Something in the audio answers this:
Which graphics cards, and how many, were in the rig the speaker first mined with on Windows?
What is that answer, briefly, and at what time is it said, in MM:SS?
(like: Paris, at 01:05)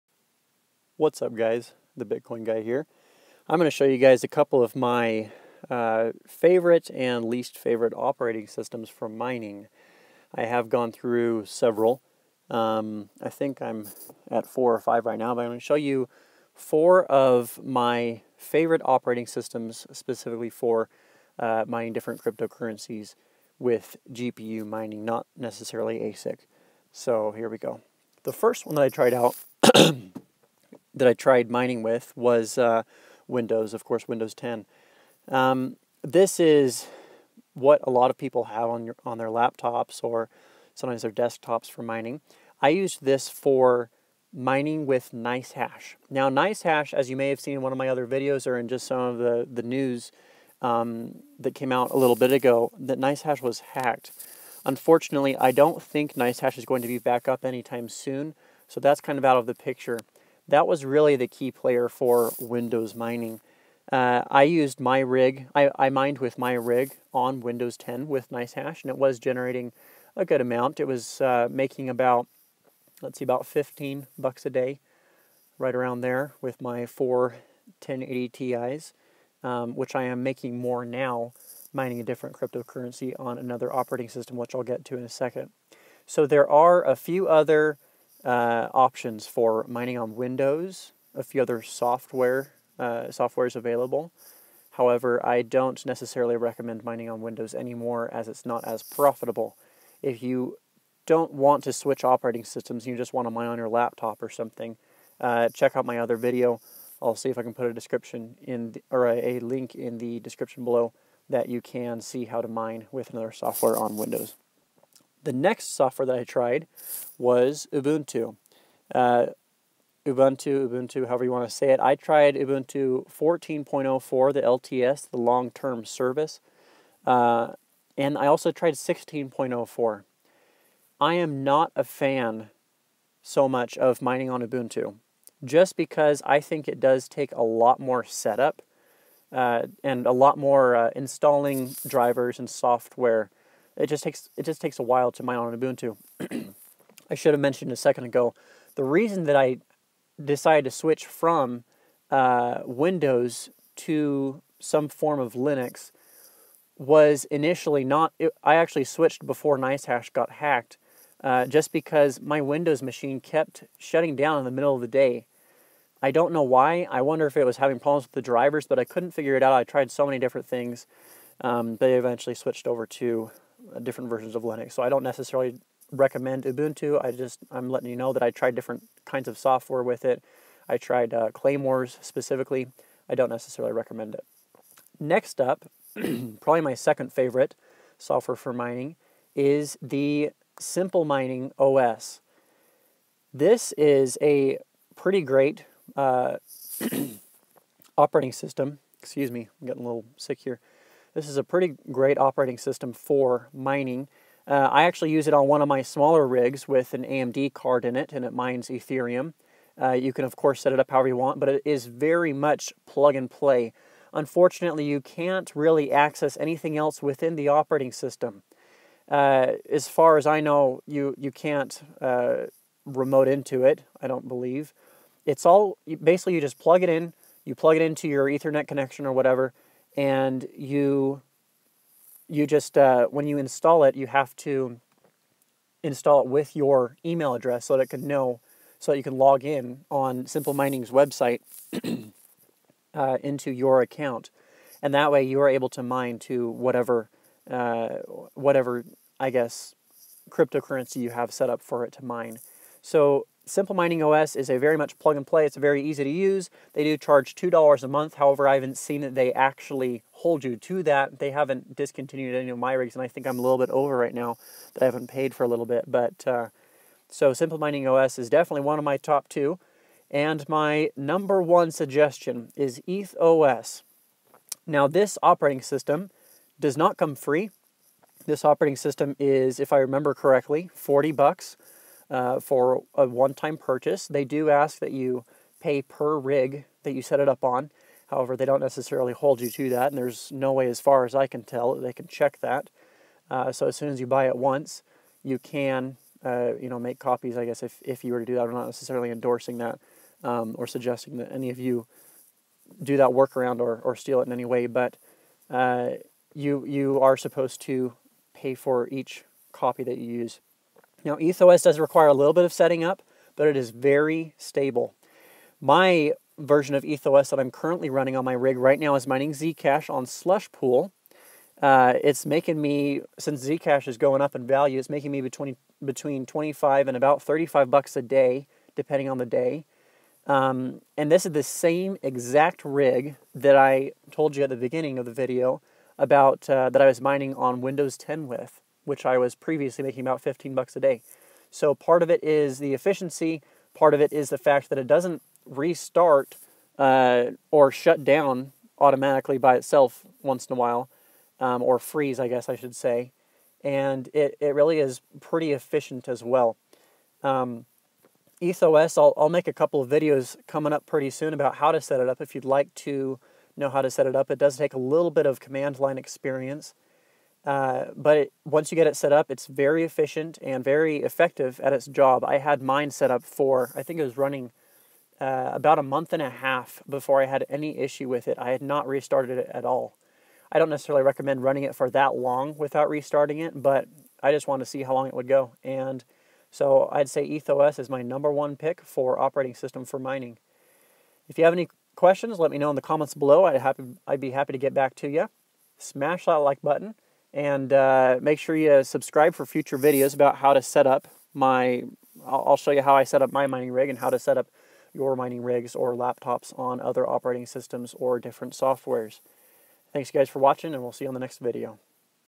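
four 1080 Ti's, at 01:16.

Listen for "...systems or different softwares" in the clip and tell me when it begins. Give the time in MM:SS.
06:47.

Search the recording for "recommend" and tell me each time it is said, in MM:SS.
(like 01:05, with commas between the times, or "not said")
01:36, 02:55, 03:03, 06:21.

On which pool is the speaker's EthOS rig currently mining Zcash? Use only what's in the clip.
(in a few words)
Slush Pool.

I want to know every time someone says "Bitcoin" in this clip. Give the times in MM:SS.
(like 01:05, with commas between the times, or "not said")
00:02.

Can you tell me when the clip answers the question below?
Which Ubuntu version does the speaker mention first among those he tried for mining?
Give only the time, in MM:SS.
02:03.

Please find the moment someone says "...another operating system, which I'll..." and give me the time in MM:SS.
01:23.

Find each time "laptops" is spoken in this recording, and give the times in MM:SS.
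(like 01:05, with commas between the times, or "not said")
00:39, 01:43, 06:45.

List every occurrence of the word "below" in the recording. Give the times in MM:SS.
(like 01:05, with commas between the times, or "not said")
01:50, 06:33.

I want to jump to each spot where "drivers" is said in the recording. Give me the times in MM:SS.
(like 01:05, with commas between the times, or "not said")
02:21, 02:48.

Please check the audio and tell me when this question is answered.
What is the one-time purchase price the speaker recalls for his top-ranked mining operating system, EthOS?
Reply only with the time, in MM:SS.
04:40.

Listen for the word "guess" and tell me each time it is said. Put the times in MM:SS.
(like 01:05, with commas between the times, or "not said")
04:09, 04:57, 05:52.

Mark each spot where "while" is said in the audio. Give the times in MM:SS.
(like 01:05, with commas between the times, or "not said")
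02:24, 05:50.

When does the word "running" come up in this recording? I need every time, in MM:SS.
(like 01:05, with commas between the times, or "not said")
05:17, 06:14, 06:21.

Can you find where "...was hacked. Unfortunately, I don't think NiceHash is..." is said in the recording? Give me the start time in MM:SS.
00:53.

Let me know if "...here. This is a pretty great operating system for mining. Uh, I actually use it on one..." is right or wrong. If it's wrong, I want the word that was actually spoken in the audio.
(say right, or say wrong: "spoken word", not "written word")
right.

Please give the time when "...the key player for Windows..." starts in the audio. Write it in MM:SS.
01:01.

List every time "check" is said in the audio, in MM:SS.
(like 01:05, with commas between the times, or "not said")
01:45, 04:52.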